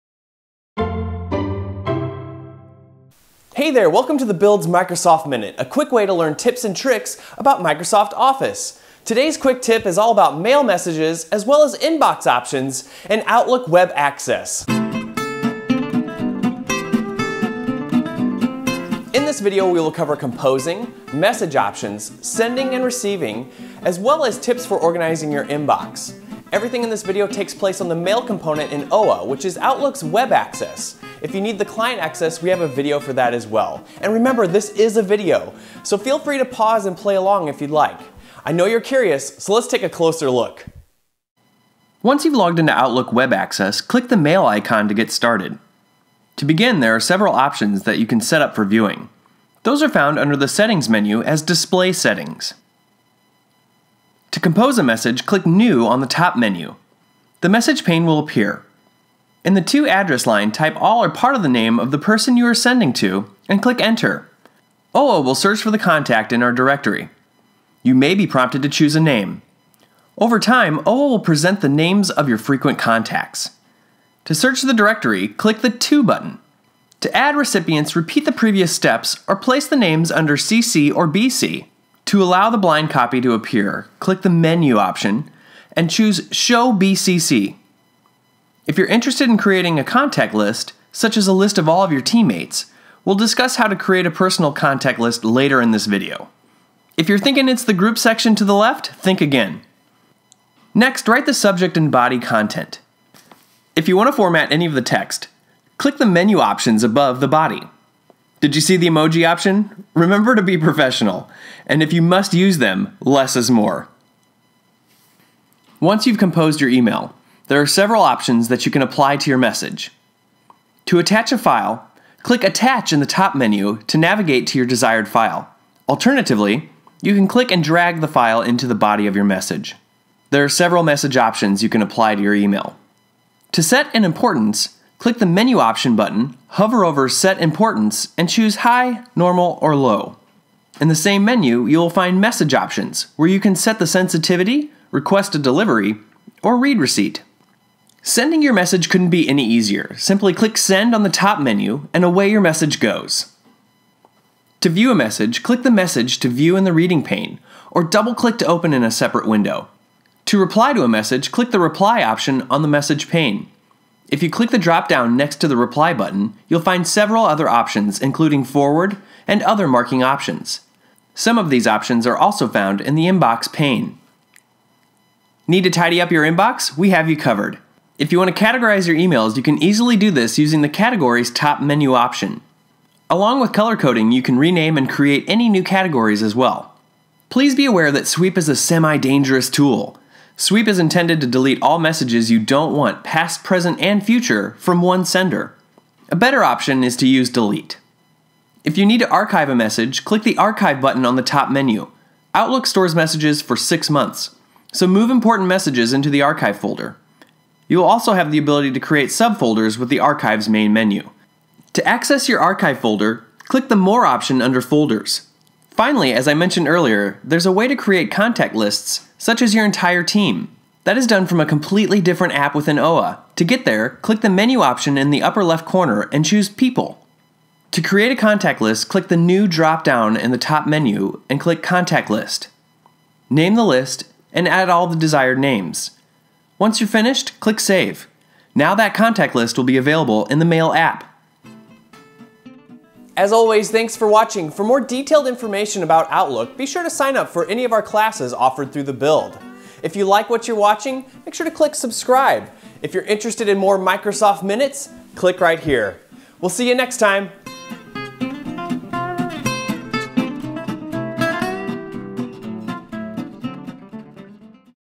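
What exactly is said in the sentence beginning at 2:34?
To view a message, click the message to view in the reading pane, or double click to open in a separate window.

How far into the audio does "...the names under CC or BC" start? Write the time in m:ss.
1:19.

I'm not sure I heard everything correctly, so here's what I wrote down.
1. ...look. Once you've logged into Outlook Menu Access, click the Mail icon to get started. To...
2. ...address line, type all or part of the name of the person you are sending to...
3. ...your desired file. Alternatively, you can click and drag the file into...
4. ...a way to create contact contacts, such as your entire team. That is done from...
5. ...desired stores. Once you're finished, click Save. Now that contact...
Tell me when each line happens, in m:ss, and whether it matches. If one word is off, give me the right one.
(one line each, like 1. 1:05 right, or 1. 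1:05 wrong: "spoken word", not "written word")
1. 0:40 wrong: "Web", not "Menu"
2. 0:59 right
3. 2:04 right
4. 3:37 wrong: "lists", not "contacts"
5. 3:54 wrong: "names", not "stores".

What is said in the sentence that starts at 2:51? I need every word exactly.
Some of these options are also found in the Inbox pane.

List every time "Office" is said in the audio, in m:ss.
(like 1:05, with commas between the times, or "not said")
0:08.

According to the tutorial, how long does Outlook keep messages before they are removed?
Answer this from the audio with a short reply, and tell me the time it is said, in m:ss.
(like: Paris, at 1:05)
6 months, at 3:23.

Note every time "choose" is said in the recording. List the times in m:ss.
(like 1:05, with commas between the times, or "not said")
1:08, 1:25, 2:18, 3:46.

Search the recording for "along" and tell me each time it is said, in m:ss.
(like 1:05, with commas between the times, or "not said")
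0:37, 3:03.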